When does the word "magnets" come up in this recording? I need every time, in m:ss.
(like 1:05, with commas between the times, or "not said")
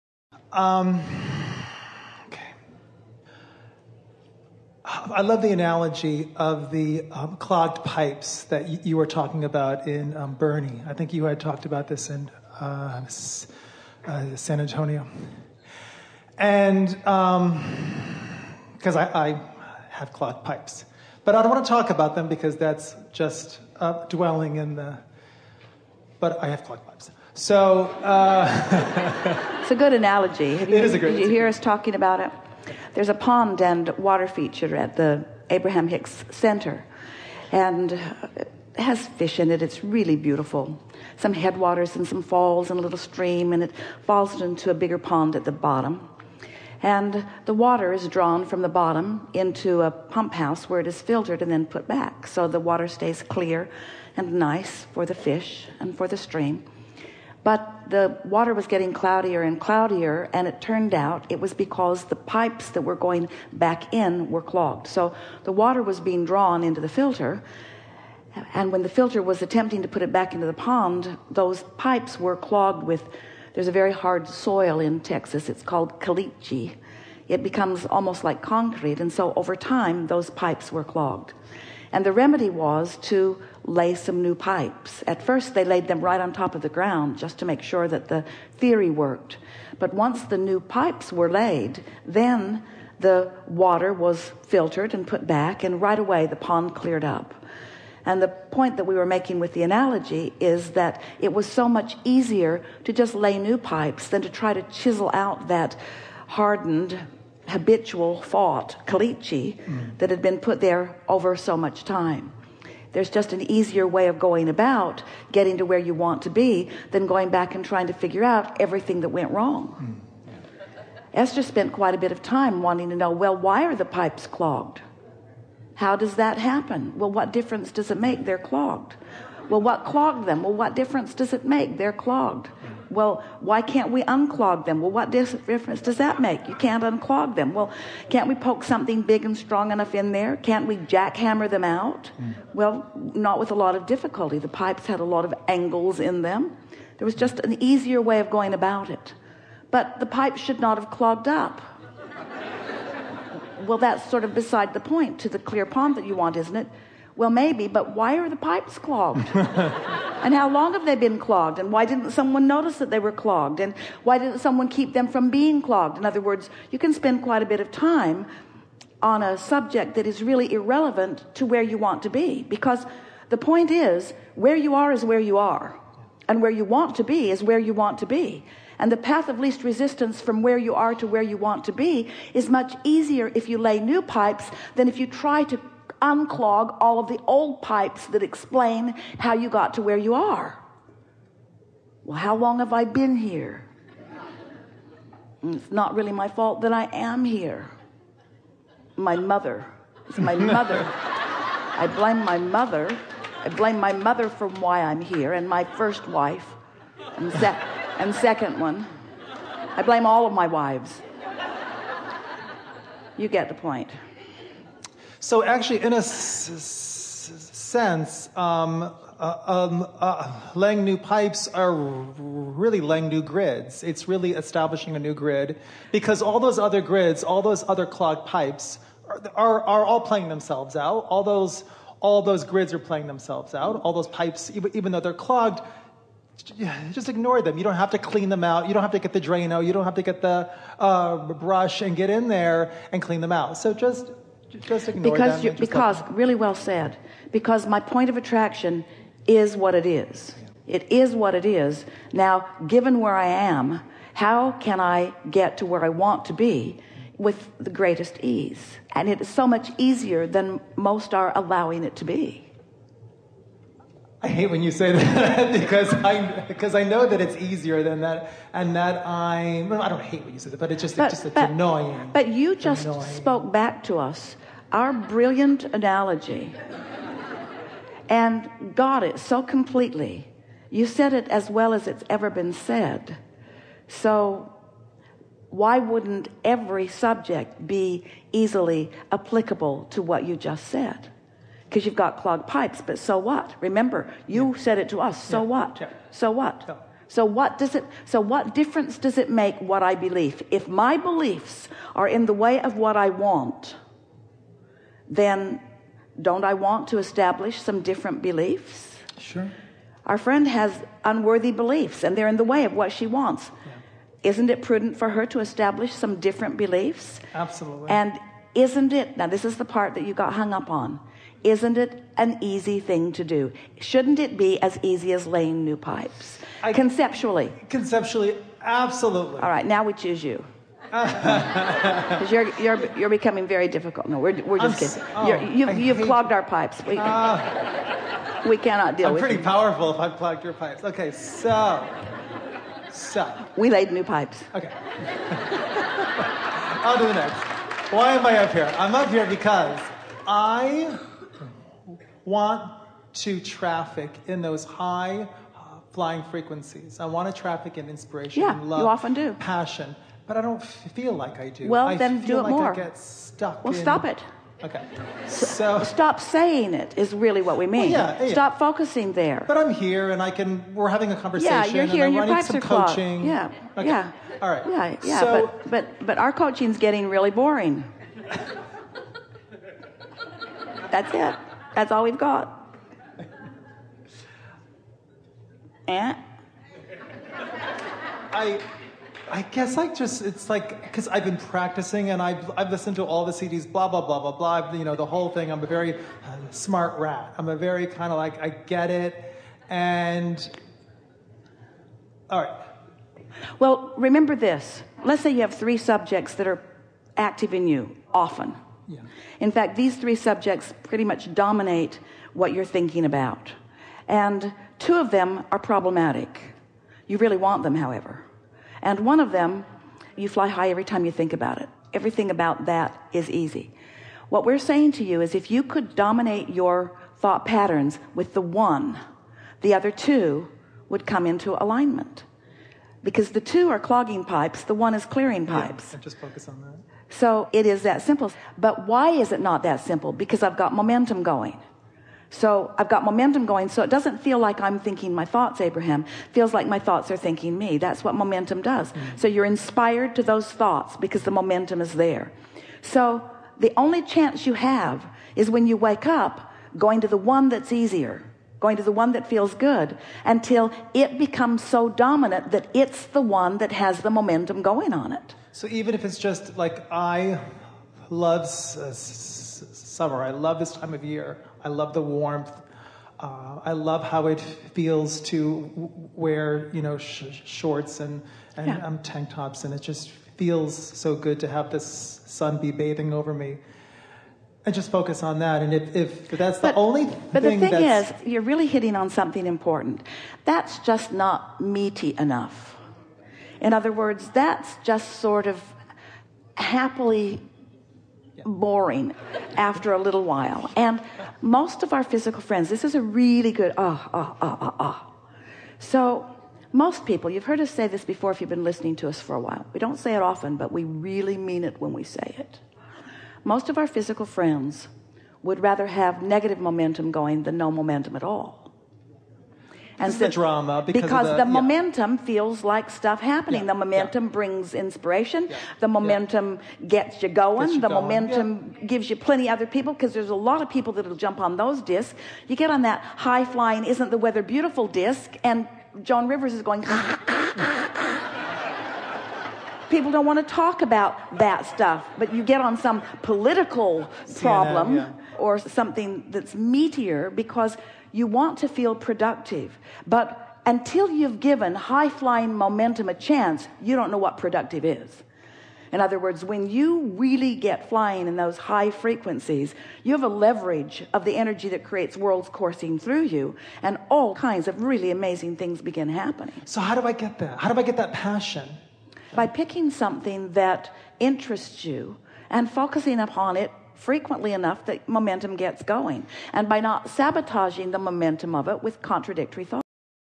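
not said.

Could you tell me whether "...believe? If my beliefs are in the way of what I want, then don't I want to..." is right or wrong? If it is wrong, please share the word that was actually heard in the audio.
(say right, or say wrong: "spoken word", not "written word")
right.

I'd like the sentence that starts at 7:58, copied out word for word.
um, tank tops, and it just feels so good to have this sun be bathing over me and just focus on that.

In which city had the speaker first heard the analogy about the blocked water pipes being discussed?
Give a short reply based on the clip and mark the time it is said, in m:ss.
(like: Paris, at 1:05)
San Antonio, at 0:14.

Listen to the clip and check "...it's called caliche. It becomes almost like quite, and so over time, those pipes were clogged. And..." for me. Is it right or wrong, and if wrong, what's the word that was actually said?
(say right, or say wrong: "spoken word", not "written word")
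wrong: "concrete", not "quite".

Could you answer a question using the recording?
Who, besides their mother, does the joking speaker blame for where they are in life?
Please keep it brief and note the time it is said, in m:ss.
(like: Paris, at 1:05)
All of my wives, at 3:30.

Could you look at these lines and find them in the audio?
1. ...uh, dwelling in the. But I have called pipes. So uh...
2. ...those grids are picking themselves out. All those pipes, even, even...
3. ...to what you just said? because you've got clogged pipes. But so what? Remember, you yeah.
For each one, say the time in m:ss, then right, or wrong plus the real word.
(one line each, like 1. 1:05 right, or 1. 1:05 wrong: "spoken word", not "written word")
1. 0:23 wrong: "clogged", not "called"
2. 3:52 wrong: "playing", not "picking"
3. 4:49 right.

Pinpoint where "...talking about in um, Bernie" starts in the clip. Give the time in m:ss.
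0:09.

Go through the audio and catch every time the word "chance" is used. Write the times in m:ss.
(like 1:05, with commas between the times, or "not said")
7:34, 9:13.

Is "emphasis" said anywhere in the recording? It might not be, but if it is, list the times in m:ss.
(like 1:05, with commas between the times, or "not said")
not said.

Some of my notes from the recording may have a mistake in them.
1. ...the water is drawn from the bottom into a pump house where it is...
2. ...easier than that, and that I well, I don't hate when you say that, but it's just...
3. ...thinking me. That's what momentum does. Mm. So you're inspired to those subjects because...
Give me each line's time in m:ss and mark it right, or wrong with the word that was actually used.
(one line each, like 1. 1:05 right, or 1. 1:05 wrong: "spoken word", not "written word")
1. 0:47 right
2. 4:27 right
3. 7:27 wrong: "thoughts", not "subjects".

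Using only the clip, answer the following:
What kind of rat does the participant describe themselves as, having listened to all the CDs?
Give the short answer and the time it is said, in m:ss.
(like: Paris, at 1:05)
Smart rat, at 6:36.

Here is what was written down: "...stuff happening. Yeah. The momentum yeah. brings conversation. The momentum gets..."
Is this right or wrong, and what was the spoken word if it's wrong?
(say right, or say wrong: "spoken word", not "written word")
wrong: "inspiration", not "conversation".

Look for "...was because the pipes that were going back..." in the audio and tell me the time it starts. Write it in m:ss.
1:01.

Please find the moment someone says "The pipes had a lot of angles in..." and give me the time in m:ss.
2:24.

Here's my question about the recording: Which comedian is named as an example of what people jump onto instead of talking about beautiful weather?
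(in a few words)
Joan Rivers.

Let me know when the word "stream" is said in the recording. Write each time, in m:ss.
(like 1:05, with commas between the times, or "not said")
0:42, 0:56.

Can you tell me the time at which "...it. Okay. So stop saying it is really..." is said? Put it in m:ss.
6:04.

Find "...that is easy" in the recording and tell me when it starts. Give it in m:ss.
7:02.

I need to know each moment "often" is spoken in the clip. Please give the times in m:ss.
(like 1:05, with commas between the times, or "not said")
5:58, 6:48, 8:30.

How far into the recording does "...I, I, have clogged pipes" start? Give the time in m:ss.
0:18.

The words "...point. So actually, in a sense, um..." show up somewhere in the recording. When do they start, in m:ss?
3:33.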